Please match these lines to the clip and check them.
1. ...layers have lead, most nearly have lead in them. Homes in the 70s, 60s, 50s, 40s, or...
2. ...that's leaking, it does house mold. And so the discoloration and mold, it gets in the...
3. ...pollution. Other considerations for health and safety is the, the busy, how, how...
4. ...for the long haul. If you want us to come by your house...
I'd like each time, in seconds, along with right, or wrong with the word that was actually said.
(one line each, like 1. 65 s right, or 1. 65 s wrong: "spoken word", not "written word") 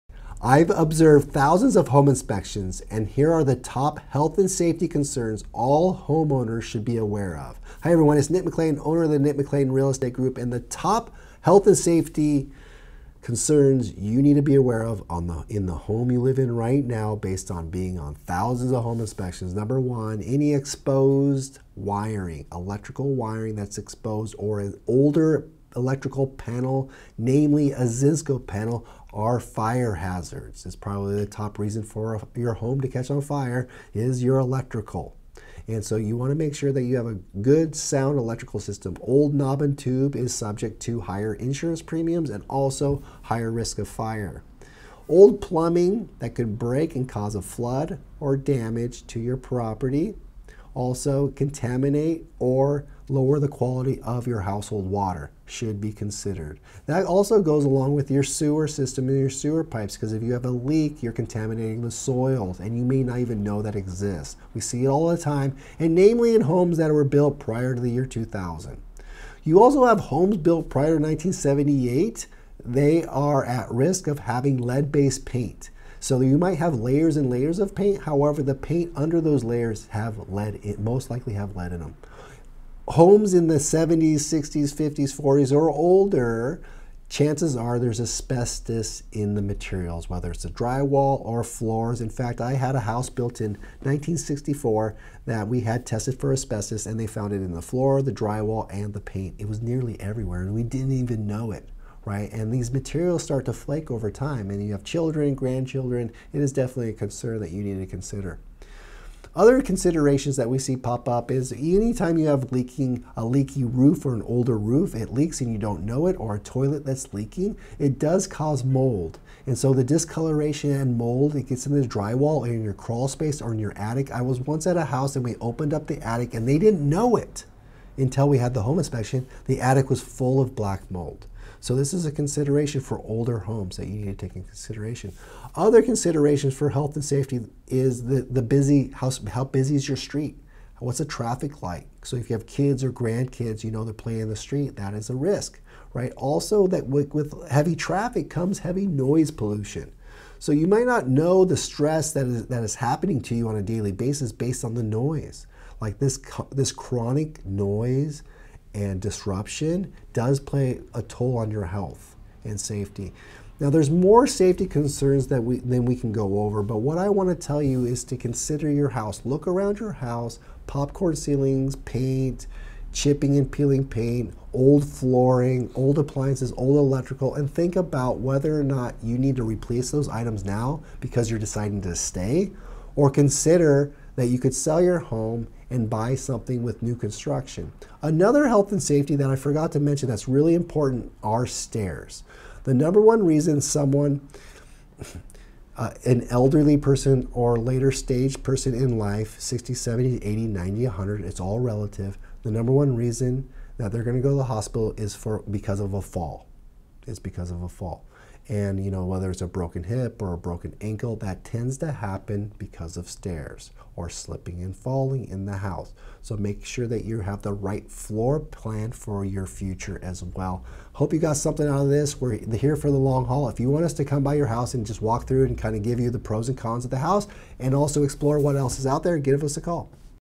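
1. 79 s wrong: "likely", not "nearly"
2. 116 s wrong: "cause", not "house"
3. 134 s wrong: "consideration", not "pollution"
4. 222 s right.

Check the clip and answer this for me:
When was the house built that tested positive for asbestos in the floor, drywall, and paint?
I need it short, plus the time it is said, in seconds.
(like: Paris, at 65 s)
1964, at 93 s.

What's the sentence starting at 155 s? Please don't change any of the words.
Like this, this chronic noise and disruption does play a toll on your health and safety.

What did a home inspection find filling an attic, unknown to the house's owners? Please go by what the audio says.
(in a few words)
Black mold.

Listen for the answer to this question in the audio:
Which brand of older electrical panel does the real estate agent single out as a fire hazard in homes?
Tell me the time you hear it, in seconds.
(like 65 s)
27 s.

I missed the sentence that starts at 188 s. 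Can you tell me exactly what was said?
Another health and safety that I forgot to mention that's really important are stairs.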